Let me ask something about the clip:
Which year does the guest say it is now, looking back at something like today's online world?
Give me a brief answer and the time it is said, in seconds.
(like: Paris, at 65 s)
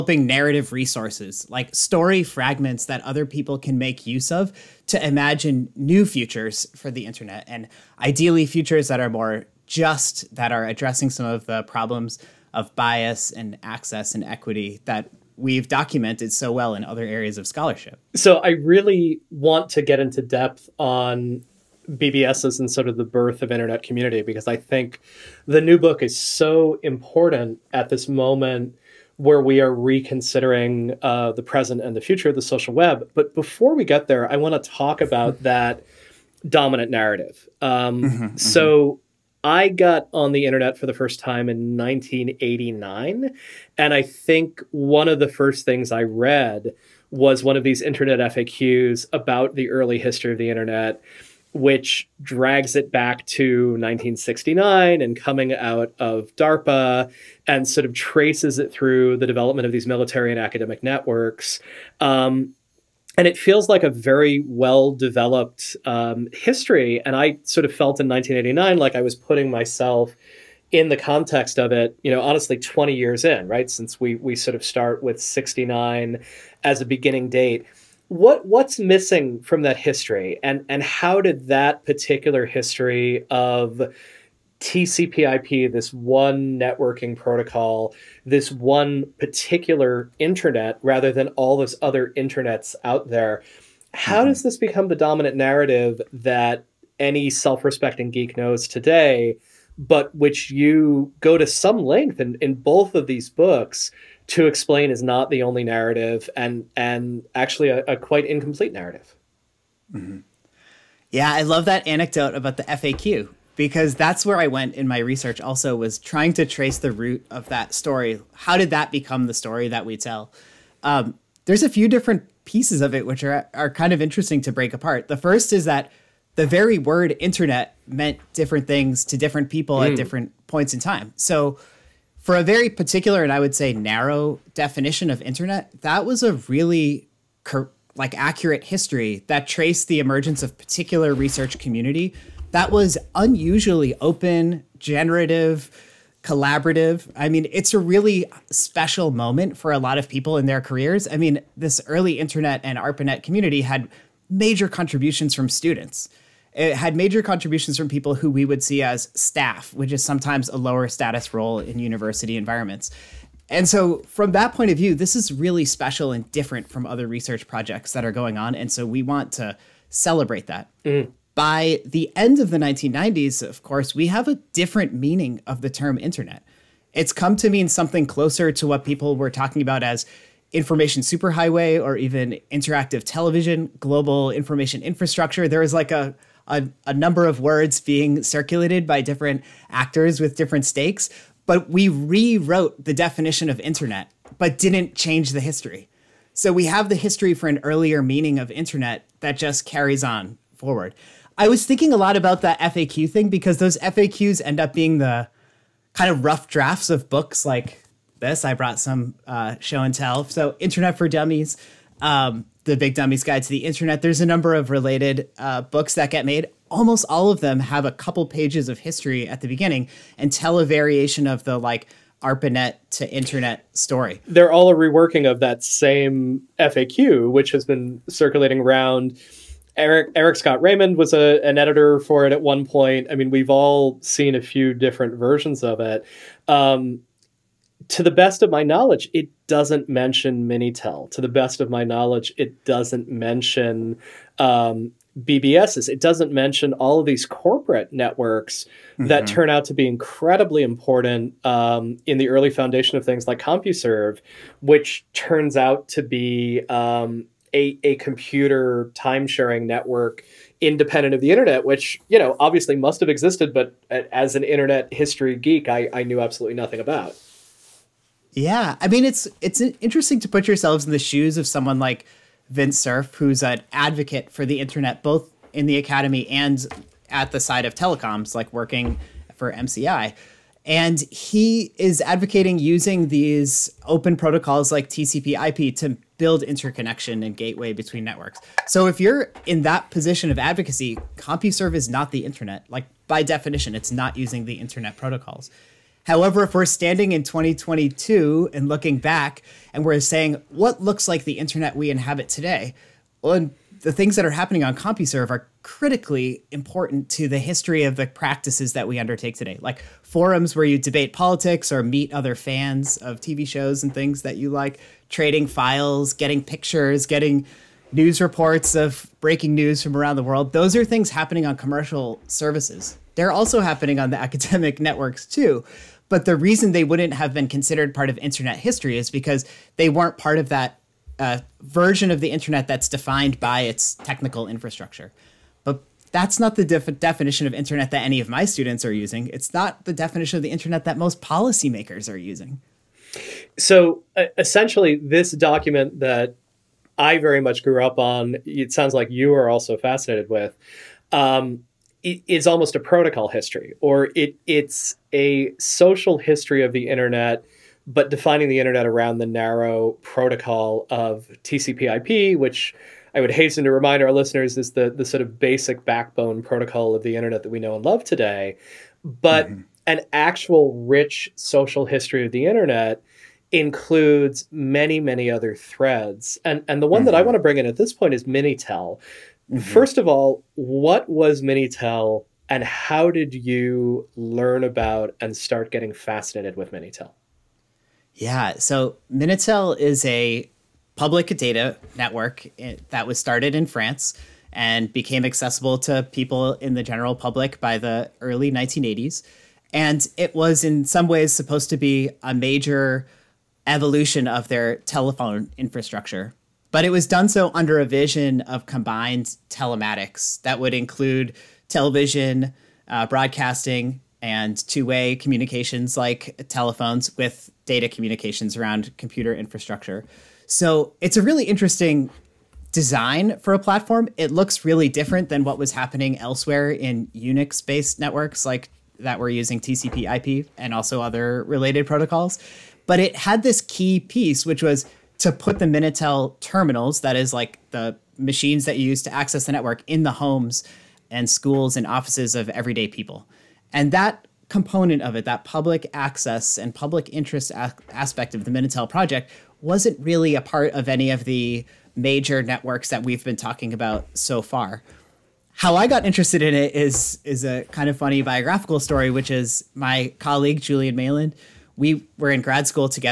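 2022, at 297 s.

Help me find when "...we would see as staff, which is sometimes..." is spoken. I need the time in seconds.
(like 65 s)
158 s.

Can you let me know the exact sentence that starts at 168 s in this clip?
And so, we want to celebrate that.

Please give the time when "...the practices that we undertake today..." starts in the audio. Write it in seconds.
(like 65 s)
307 s.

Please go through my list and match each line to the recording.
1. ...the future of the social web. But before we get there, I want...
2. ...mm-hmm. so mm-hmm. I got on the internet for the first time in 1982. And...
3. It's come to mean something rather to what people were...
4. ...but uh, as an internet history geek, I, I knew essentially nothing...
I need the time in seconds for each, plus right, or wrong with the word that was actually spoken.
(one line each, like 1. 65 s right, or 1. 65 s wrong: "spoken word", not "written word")
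1. 31 s right
2. 38 s wrong: "1989", not "1982"
3. 176 s wrong: "closer", not "rather"
4. 263 s wrong: "absolutely", not "essentially".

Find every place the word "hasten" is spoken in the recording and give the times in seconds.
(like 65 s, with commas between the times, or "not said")
363 s.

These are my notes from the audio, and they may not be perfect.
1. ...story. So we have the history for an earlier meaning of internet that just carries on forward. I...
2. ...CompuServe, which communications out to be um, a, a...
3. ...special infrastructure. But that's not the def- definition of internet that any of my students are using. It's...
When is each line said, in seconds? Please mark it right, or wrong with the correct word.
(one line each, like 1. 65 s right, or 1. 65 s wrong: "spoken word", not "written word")
1. 195 s wrong: "history", not "story"
2. 253 s wrong: "turns", not "communications"
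3. 333 s wrong: "technical", not "special".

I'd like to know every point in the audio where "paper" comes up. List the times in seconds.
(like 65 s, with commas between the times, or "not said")
not said.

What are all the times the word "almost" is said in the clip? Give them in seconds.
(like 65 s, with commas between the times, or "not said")
216 s, 352 s.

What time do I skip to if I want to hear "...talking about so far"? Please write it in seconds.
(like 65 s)
453 s.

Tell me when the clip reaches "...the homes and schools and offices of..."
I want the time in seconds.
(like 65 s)
440 s.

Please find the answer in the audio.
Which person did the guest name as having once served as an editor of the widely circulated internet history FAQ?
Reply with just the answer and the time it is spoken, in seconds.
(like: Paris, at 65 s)
Eric Scott Raymond, at 230 s.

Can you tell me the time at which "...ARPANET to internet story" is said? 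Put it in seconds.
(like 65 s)
222 s.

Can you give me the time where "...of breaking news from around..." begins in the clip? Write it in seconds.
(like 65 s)
318 s.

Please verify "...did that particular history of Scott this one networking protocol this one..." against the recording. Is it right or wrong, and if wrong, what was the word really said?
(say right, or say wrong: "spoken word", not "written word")
wrong: "TCPIP", not "Scott".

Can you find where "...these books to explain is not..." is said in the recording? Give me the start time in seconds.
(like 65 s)
103 s.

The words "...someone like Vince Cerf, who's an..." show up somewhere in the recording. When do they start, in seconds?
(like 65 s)
271 s.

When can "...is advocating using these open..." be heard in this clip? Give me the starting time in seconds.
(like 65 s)
281 s.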